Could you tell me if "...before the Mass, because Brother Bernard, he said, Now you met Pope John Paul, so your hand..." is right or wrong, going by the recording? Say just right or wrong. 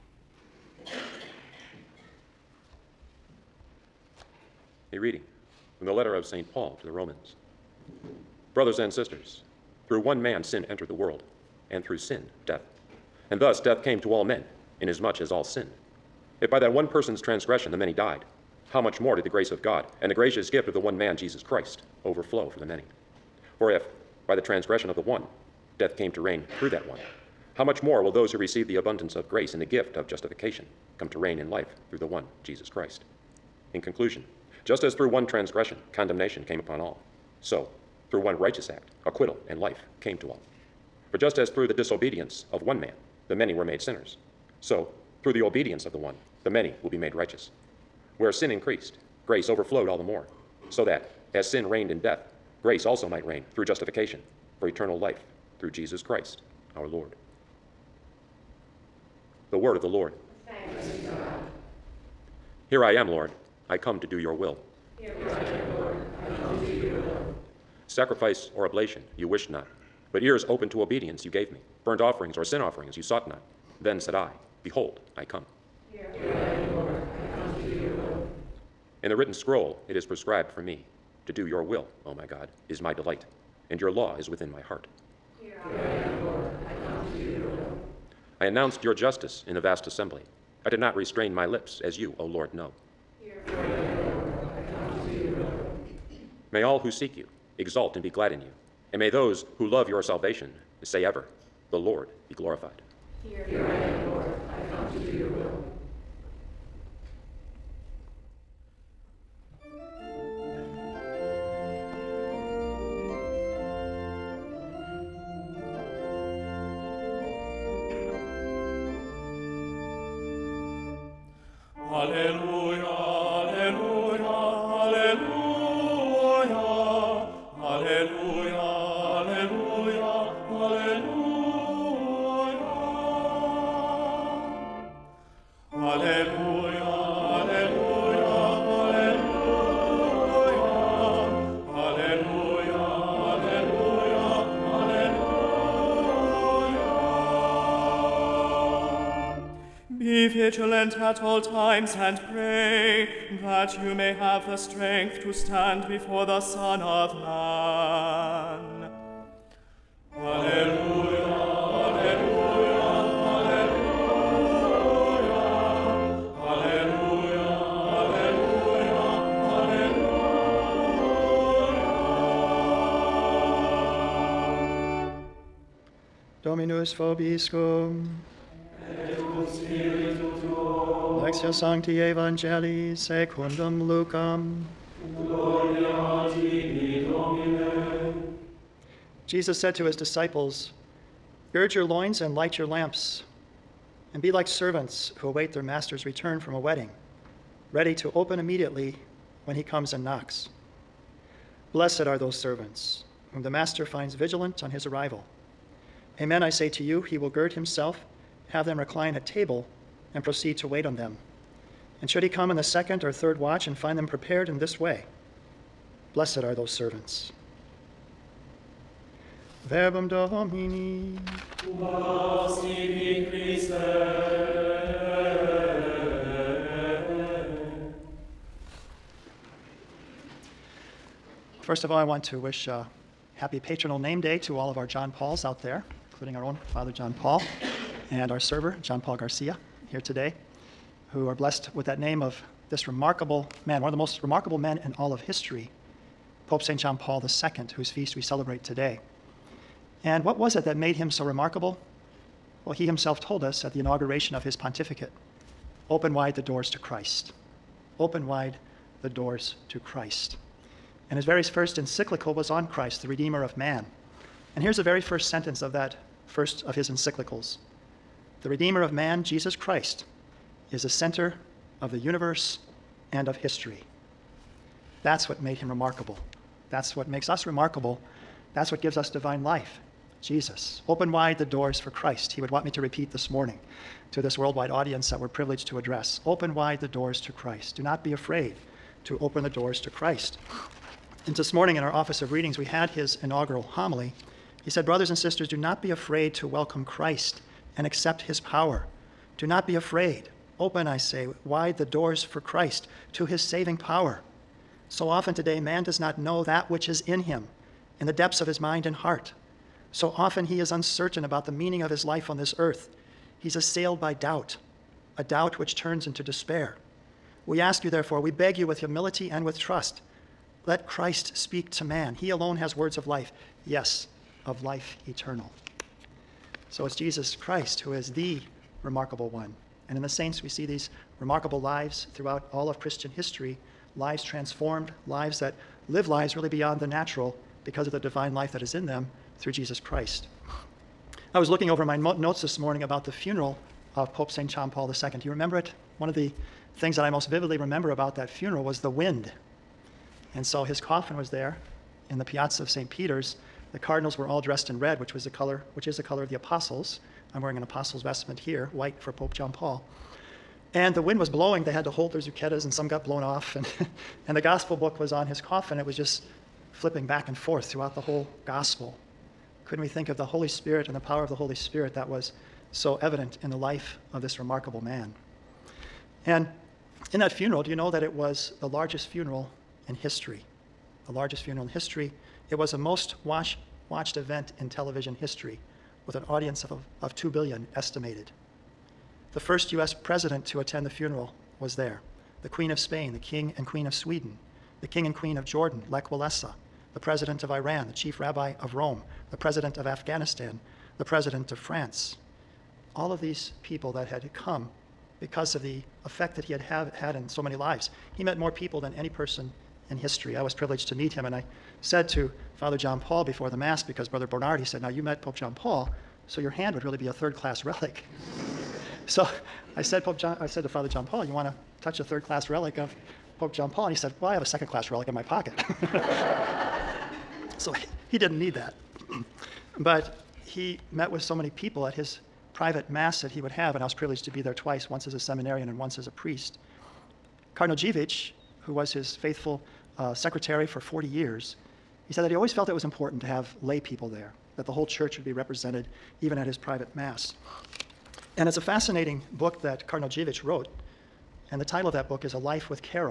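right.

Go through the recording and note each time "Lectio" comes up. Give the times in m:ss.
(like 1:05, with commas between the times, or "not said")
3:01.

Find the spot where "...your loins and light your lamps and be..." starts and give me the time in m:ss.
3:11.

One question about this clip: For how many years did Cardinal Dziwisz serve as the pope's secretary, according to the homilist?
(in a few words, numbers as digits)
40.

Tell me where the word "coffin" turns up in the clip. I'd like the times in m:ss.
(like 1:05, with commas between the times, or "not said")
5:50, 6:05.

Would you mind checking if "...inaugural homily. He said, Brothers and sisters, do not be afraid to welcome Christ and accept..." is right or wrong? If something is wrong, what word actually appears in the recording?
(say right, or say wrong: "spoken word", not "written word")
right.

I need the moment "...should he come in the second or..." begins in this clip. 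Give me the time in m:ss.
3:32.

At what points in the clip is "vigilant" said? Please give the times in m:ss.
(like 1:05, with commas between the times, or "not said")
2:30, 3:24.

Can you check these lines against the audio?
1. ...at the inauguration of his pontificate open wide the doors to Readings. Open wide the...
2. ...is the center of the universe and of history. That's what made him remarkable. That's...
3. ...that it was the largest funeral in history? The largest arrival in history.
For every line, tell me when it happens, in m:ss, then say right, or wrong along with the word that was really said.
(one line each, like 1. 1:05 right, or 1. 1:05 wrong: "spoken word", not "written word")
1. 4:13 wrong: "Christ", not "Readings"
2. 4:30 right
3. 6:17 wrong: "funeral", not "arrival".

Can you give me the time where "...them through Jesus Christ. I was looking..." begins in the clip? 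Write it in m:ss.
5:38.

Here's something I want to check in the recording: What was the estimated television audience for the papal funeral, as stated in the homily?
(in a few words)
2 billion.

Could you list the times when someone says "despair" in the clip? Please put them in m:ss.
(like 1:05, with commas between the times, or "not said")
5:16.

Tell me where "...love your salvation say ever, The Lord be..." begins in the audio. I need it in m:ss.
1:39.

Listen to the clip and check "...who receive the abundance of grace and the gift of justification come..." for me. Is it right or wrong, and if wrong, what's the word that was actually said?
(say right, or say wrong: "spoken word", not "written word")
right.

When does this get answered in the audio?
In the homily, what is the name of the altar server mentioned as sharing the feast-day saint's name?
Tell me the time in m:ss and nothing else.
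3:58.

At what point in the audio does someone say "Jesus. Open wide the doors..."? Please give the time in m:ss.
4:40.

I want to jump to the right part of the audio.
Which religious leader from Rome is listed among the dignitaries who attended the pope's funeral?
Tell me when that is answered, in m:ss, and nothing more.
6:37.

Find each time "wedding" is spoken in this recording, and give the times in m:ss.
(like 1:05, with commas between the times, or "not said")
3:16.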